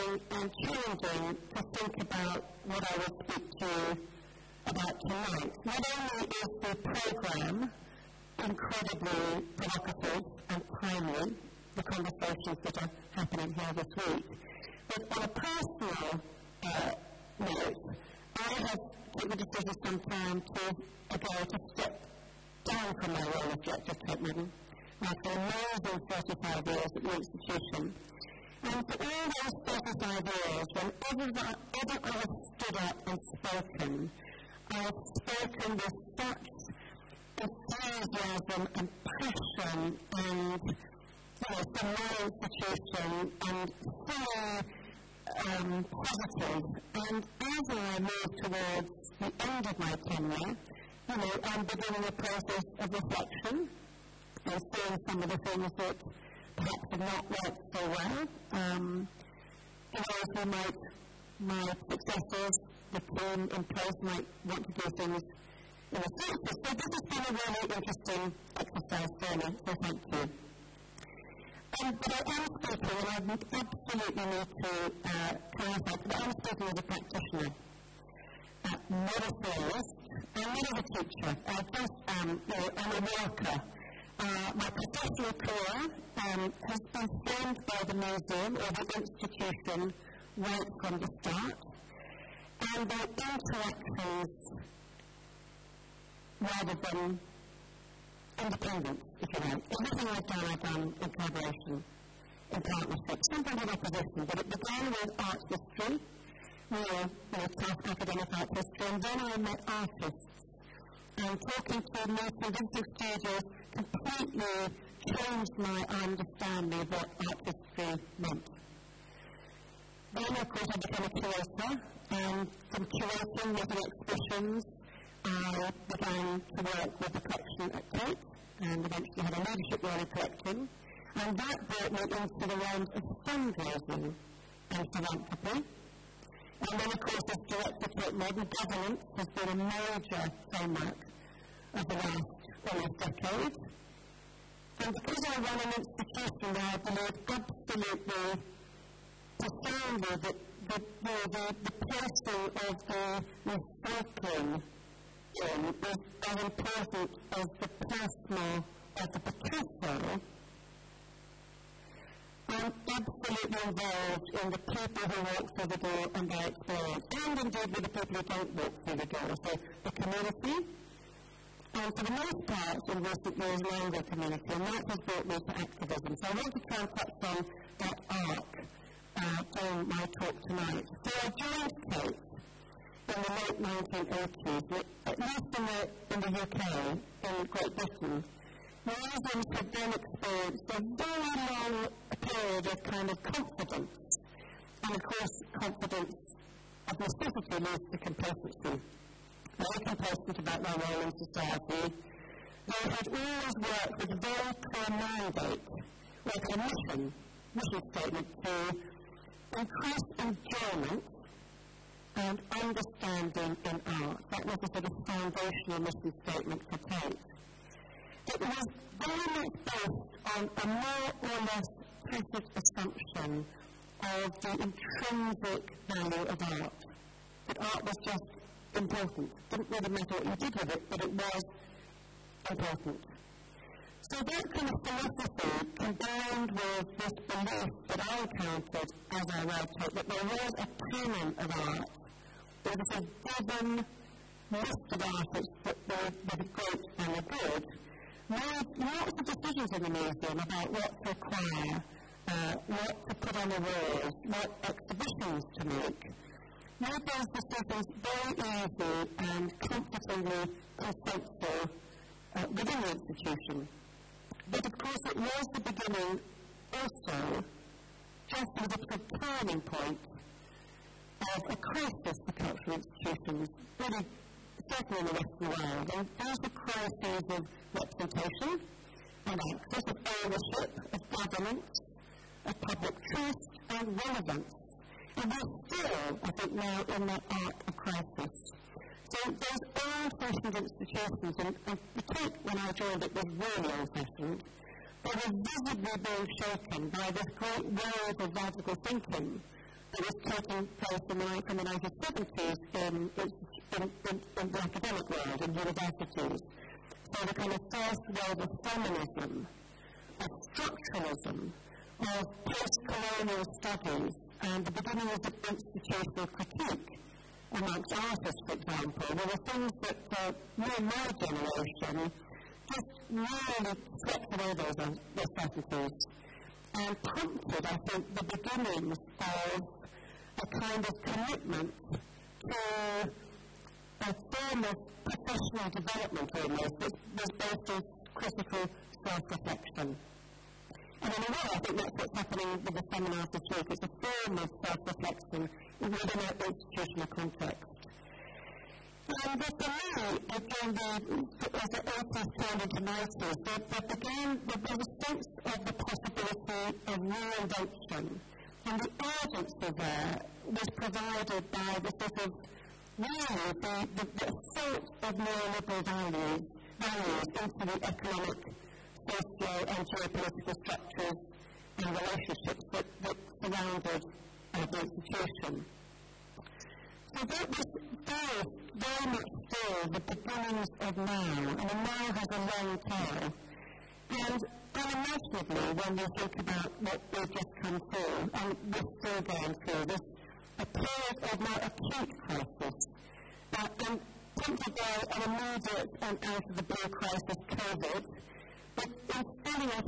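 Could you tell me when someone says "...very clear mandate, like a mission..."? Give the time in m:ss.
3:24.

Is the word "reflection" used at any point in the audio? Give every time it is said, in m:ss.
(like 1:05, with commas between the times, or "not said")
0:52, 5:39, 5:44.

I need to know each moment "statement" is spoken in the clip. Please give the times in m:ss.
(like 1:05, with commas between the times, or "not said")
3:27, 3:36.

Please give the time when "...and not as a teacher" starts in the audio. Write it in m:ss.
1:20.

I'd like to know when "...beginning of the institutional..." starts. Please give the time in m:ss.
5:14.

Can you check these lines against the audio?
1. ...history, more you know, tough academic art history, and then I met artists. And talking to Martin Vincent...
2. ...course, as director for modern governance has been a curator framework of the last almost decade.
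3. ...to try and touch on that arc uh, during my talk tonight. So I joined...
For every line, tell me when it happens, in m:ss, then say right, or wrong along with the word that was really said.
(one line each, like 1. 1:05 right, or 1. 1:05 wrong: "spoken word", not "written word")
1. 1:45 right
2. 2:16 wrong: "major", not "curator"
3. 2:56 right.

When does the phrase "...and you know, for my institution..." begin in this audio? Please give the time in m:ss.
0:40.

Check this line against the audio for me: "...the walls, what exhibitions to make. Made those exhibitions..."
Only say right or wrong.
wrong.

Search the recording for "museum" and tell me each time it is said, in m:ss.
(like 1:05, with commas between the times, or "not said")
1:27, 3:08, 4:09.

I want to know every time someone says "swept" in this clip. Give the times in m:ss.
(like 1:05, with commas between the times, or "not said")
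5:24.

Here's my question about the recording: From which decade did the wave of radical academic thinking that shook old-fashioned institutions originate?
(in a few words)
1970s.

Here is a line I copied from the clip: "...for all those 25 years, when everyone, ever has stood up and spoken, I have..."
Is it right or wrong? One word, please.
wrong.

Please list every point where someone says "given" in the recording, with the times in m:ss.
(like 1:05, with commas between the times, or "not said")
0:19, 4:03.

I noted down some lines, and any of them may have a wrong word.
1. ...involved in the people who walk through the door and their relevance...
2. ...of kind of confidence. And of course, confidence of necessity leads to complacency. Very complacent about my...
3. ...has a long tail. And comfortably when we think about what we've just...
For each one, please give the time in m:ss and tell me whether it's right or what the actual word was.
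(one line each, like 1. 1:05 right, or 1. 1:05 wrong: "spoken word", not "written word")
1. 2:43 wrong: "experience", not "relevance"
2. 3:12 right
3. 6:22 wrong: "unimaginably", not "comfortably".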